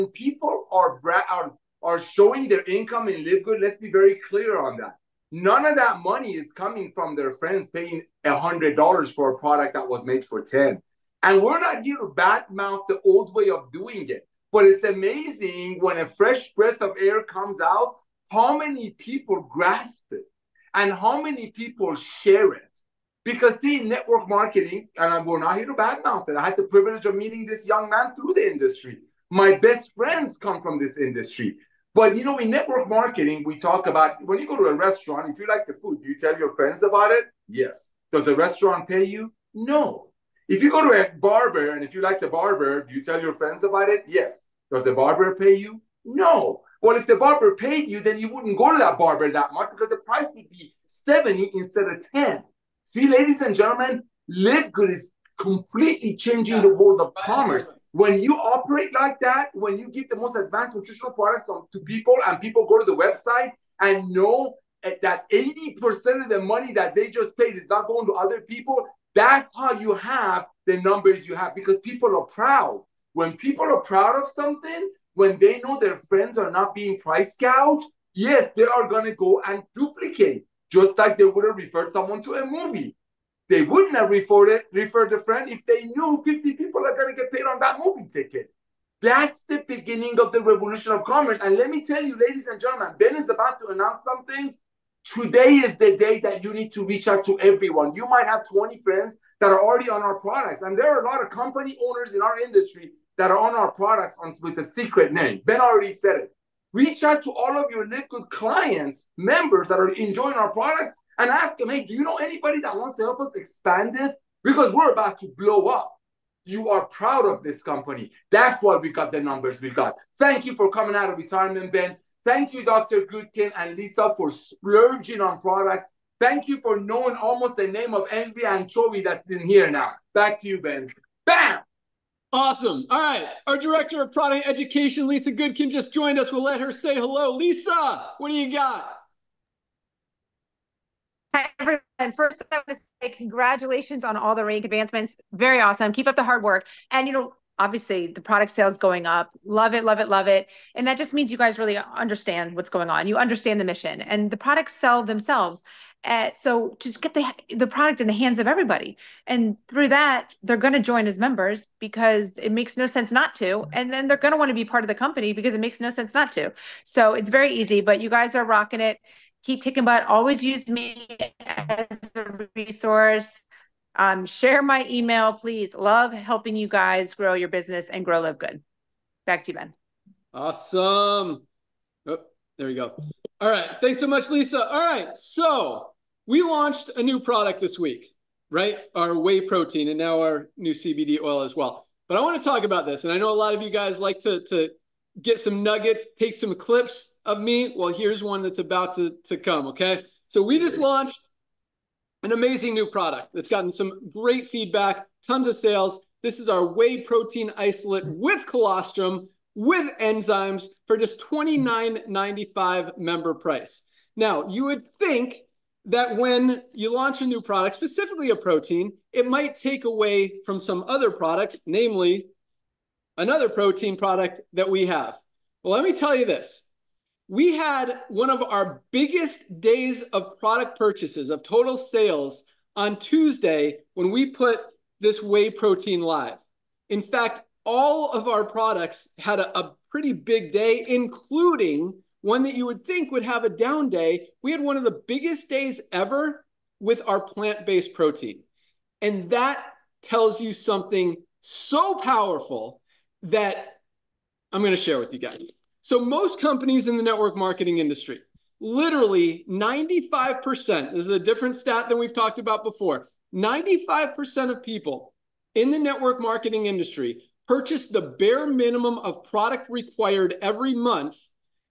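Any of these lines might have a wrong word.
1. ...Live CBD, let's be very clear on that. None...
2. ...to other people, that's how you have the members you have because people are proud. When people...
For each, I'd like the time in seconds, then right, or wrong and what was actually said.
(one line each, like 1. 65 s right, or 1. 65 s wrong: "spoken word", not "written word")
1. 3 s wrong: "Good", not "CBD"
2. 68 s wrong: "numbers", not "members".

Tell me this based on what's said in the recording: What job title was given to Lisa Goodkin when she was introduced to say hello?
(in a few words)
Director of product education.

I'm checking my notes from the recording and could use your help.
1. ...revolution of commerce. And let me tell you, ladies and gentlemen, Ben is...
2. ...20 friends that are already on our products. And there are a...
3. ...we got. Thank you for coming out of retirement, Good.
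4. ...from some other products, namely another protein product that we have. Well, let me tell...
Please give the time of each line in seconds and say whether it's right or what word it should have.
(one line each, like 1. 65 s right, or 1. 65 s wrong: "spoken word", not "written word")
1. 90 s right
2. 98 s right
3. 119 s wrong: "Ben", not "Good"
4. 220 s right.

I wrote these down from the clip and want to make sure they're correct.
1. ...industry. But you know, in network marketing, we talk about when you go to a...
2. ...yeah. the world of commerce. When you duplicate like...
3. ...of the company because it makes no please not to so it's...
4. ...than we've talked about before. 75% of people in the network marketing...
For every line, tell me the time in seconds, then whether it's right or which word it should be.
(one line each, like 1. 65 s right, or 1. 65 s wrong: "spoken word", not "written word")
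1. 30 s right
2. 56 s wrong: "operate", not "duplicate"
3. 164 s wrong: "sense", not "please"
4. 261 s wrong: "95", not "75".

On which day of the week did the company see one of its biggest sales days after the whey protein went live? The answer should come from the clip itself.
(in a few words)
Tuesday.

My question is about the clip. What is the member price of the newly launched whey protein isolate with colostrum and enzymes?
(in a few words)
$29.95.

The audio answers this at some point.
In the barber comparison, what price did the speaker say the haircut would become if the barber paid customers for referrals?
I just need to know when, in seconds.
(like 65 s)
50 s.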